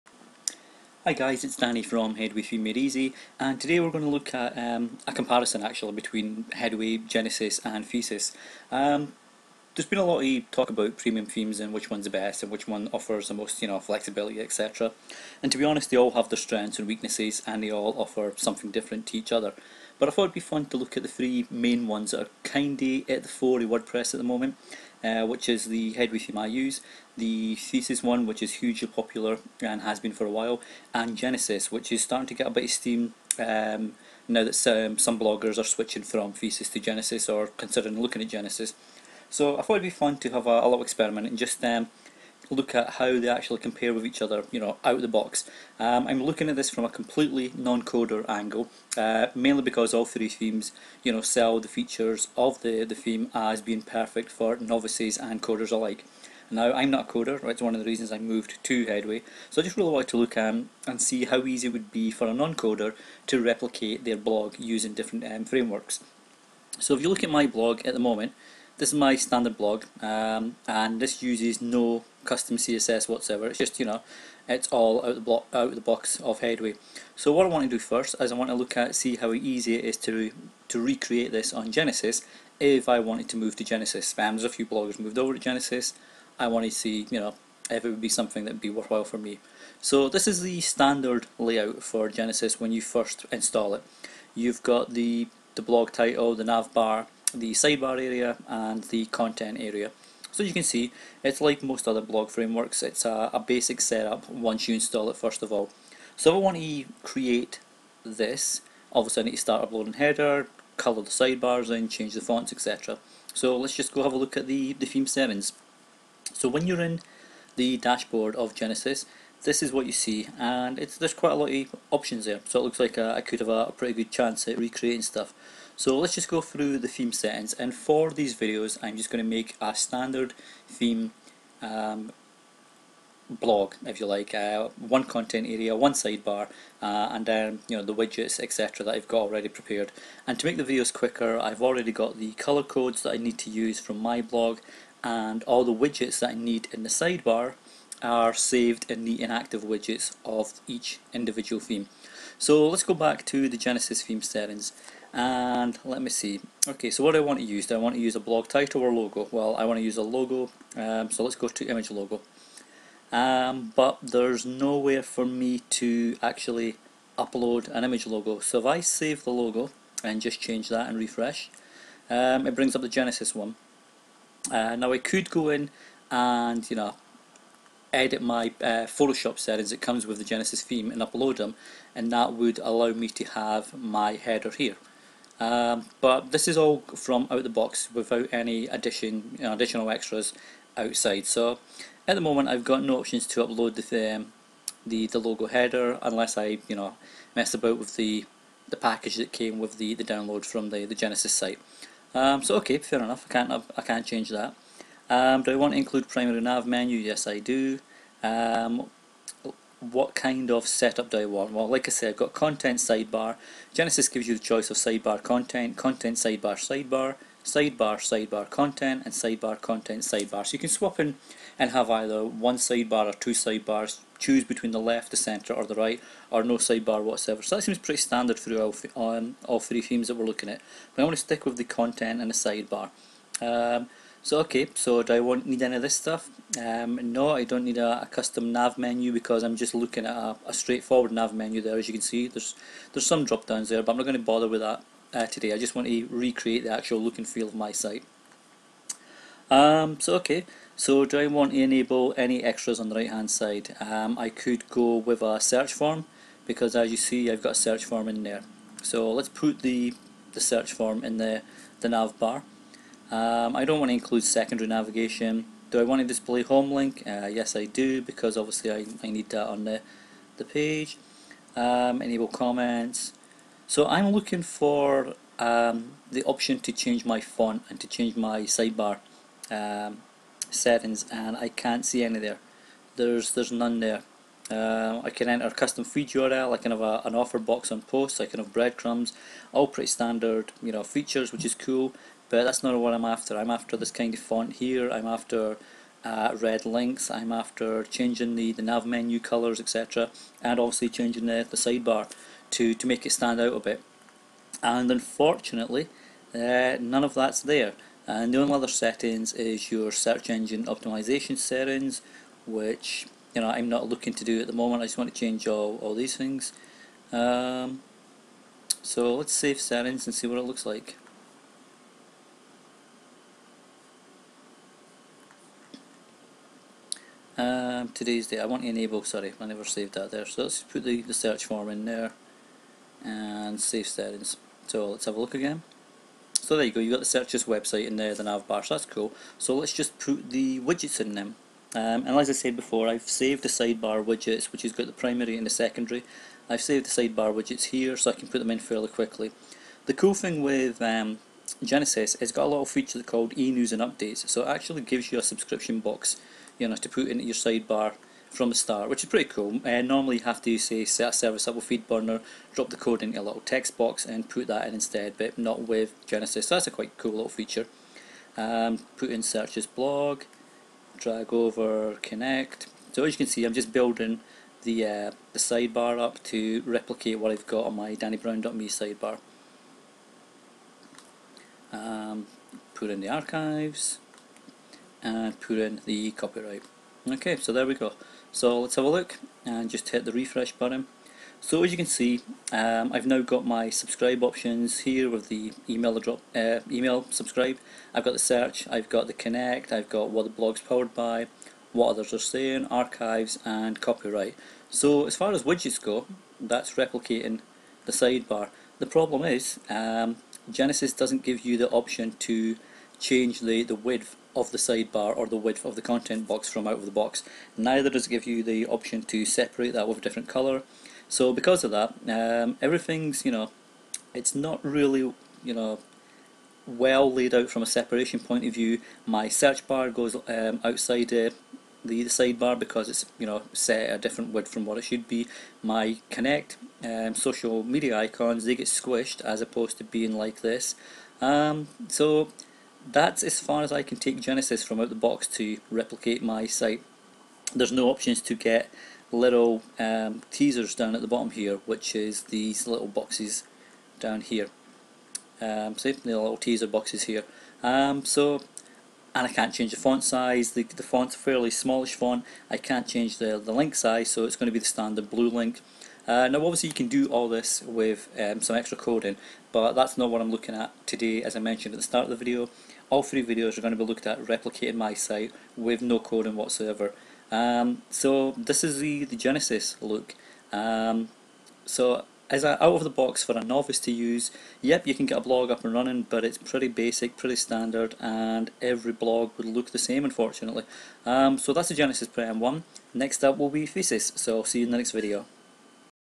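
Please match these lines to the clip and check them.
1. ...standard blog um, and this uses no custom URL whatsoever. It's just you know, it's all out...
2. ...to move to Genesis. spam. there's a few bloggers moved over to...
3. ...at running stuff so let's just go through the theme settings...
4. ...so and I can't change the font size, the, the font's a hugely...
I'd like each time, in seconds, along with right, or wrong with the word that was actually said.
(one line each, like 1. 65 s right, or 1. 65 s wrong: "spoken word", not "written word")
1. 69 s wrong: "CSS", not "URL"
2. 83 s right
3. 124 s wrong: "recreating", not "running"
4. 458 s wrong: "fairly", not "hugely".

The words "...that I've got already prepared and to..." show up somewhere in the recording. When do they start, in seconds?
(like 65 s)
138 s.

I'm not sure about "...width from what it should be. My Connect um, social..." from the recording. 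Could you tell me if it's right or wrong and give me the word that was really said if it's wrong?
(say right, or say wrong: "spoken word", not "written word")
right.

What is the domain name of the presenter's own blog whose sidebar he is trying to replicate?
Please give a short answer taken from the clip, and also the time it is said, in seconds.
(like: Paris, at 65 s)
dannybrown.me, at 377 s.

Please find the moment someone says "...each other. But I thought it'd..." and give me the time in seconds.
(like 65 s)
19 s.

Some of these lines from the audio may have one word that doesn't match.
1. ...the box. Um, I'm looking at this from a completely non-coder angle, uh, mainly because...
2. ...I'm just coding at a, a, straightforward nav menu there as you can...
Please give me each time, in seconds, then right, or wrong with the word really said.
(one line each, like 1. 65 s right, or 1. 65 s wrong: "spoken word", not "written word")
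1. 45 s right
2. 239 s wrong: "looking", not "coding".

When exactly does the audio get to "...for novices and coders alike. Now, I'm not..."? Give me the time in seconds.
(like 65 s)
54 s.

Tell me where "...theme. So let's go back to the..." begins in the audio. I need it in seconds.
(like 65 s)
151 s.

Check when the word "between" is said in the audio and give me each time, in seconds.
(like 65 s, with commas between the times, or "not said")
5 s, 224 s.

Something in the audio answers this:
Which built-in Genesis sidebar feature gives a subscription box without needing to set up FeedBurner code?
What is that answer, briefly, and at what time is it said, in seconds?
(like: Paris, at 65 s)
e-news and updates, at 353 s.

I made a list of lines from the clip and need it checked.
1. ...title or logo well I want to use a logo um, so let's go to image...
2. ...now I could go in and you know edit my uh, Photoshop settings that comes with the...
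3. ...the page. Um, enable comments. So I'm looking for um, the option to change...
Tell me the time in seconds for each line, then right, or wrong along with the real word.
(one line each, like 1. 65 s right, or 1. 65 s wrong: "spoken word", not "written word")
1. 158 s right
2. 174 s right
3. 270 s right.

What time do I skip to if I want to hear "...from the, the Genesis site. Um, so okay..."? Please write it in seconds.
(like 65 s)
200 s.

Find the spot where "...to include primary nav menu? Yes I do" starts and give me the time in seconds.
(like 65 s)
205 s.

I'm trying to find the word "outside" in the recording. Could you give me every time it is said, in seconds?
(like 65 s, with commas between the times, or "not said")
190 s, 430 s.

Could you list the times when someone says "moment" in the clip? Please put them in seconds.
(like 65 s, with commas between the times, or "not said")
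24 s, 68 s, 192 s, 314 s.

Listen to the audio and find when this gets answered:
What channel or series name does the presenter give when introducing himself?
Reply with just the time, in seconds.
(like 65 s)
2 s.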